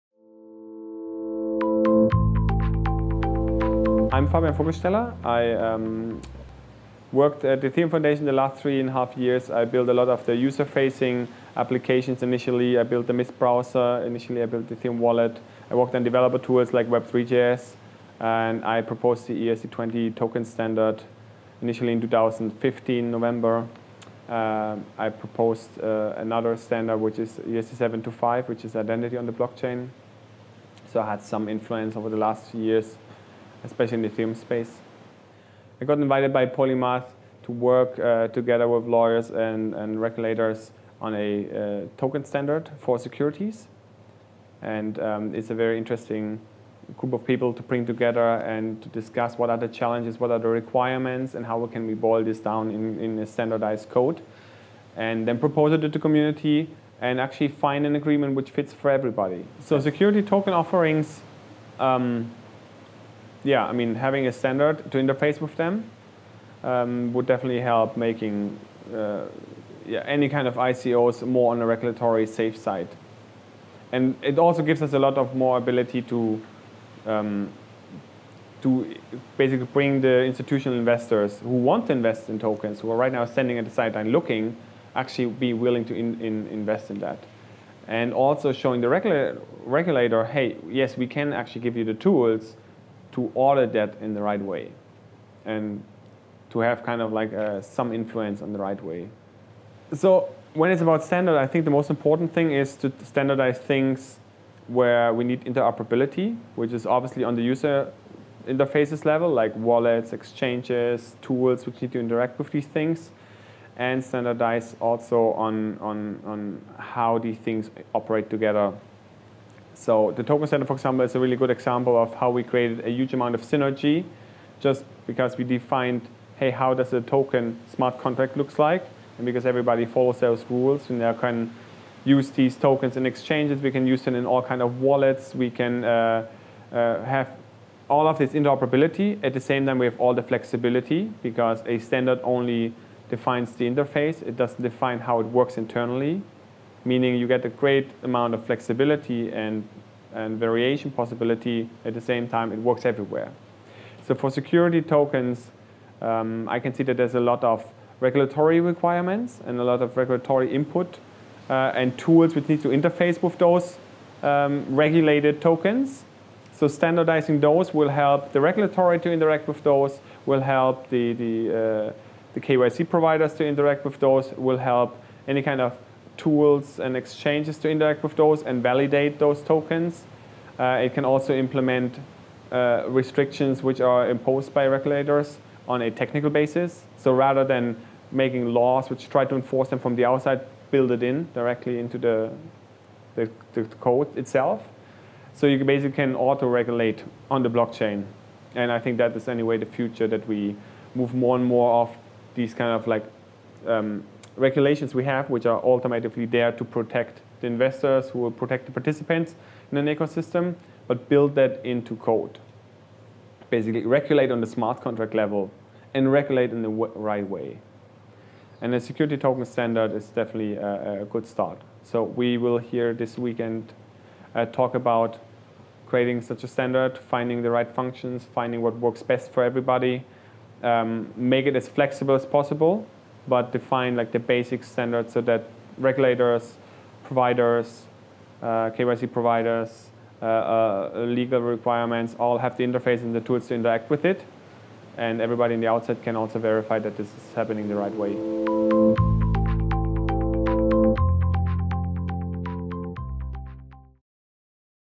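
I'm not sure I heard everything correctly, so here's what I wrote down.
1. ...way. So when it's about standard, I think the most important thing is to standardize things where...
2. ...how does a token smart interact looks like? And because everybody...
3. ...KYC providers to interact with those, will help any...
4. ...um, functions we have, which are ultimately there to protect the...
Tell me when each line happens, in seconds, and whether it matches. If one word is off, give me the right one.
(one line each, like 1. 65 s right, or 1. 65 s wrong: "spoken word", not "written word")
1. 98 s right
2. 126 s wrong: "contract", not "interact"
3. 172 s right
4. 203 s wrong: "regulations", not "functions".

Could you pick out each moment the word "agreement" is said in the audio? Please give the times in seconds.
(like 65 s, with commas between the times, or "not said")
57 s.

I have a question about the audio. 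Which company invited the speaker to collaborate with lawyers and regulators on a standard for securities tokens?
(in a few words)
Polymath.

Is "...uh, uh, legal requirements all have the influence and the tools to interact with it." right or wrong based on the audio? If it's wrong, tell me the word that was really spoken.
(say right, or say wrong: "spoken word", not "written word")
wrong: "interface", not "influence".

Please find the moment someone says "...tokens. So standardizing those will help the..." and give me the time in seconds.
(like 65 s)
165 s.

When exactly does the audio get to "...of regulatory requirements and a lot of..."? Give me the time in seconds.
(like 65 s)
157 s.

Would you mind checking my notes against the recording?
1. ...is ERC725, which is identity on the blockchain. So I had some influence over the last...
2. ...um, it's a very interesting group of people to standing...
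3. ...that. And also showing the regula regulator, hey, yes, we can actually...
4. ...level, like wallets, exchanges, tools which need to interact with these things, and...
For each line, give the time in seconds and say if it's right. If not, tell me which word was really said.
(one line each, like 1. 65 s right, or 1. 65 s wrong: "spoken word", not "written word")
1. 27 s right
2. 44 s wrong: "bring", not "standing"
3. 86 s right
4. 109 s right.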